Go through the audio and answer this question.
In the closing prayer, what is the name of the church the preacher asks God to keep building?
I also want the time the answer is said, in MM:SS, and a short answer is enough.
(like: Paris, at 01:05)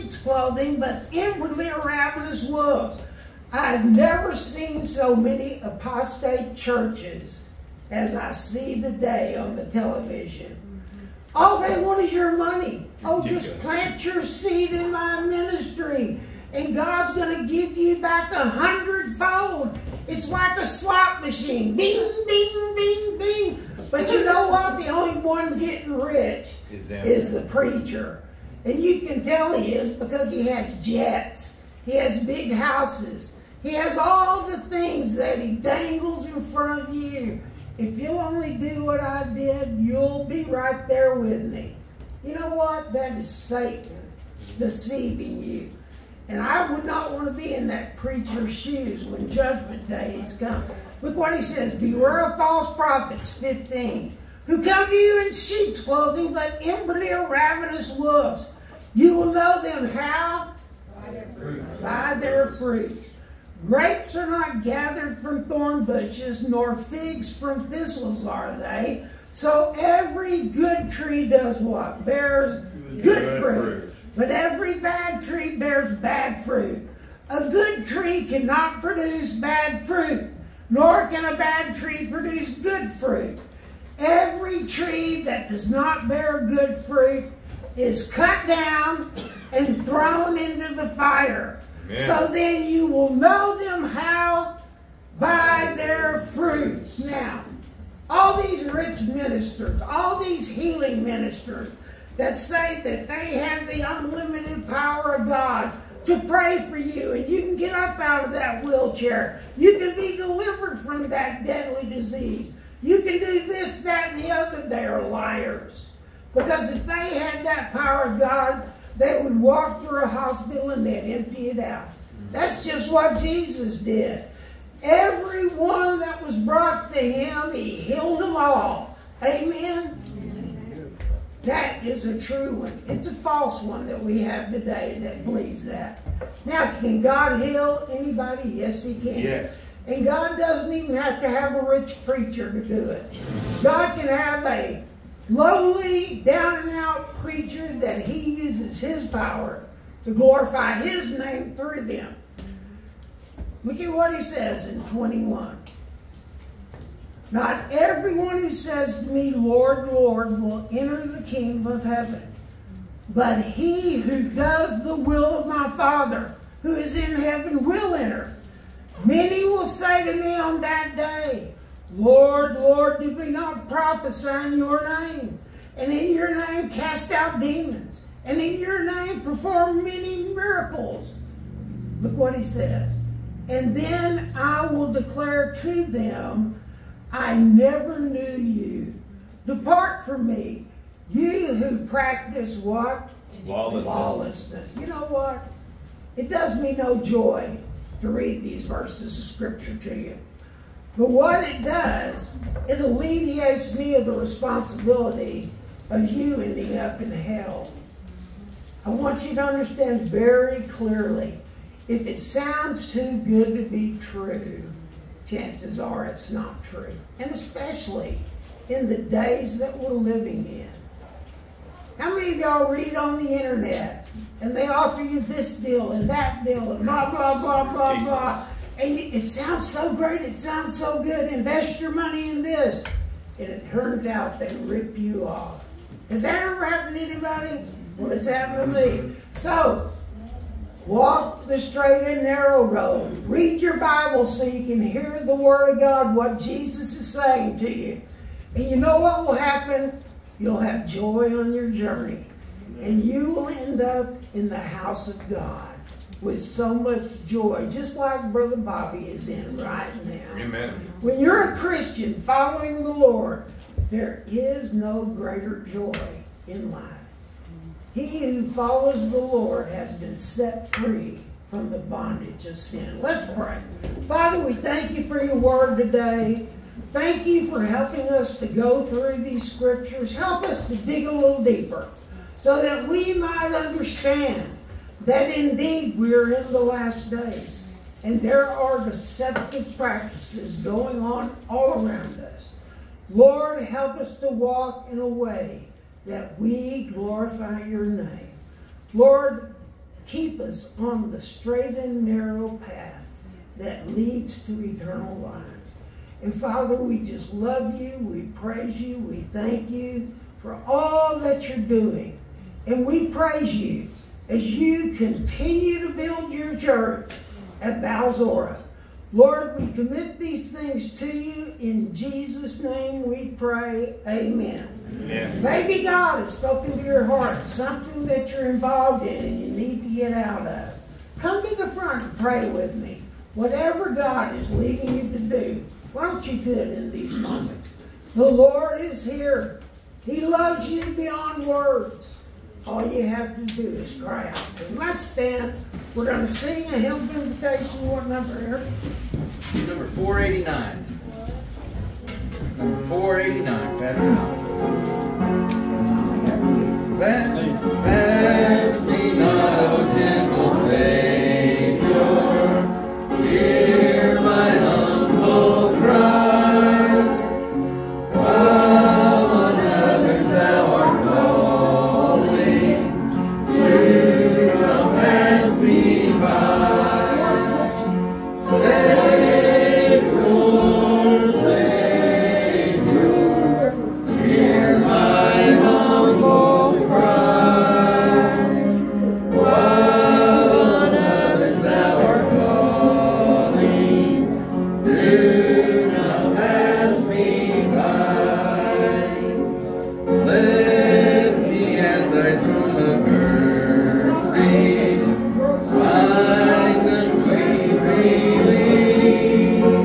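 Balsora, at 05:17.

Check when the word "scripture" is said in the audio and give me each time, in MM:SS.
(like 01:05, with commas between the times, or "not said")
03:19, 04:39.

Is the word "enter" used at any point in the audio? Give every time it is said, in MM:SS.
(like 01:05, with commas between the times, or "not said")
02:40, 02:47.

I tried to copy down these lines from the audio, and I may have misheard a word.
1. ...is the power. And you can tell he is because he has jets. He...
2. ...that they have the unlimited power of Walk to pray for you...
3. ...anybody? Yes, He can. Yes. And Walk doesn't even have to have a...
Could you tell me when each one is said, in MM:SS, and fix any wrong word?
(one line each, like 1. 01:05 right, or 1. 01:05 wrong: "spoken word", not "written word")
1. 00:26 wrong: "preacher", not "power"
2. 01:42 wrong: "God", not "Walk"
3. 02:17 wrong: "God", not "Walk".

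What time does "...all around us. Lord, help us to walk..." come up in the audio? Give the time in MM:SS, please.
04:51.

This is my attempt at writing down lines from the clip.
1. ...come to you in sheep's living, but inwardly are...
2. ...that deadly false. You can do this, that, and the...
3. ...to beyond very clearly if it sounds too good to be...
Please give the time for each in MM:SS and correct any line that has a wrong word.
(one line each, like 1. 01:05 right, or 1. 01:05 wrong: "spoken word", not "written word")
1. 00:54 wrong: "clothing", not "living"
2. 01:51 wrong: "disease", not "false"
3. 03:29 wrong: "understand", not "beyond".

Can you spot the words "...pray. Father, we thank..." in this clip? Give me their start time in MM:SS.
04:33.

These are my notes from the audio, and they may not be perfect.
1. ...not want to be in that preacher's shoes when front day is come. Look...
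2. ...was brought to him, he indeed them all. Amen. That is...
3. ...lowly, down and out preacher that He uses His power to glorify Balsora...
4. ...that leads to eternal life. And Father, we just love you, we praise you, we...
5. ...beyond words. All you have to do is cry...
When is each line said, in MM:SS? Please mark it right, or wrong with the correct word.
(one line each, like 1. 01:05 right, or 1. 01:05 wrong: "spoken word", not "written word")
1. 00:46 wrong: "judgment", not "front"
2. 02:06 wrong: "healed", not "indeed"
3. 02:25 wrong: "His", not "Balsora"
4. 05:03 right
5. 05:40 right.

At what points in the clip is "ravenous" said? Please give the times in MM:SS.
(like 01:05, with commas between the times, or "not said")
00:01, 00:57.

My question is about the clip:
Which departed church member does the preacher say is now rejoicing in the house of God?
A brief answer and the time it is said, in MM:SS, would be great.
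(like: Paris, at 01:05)
Brother Bobby, at 04:18.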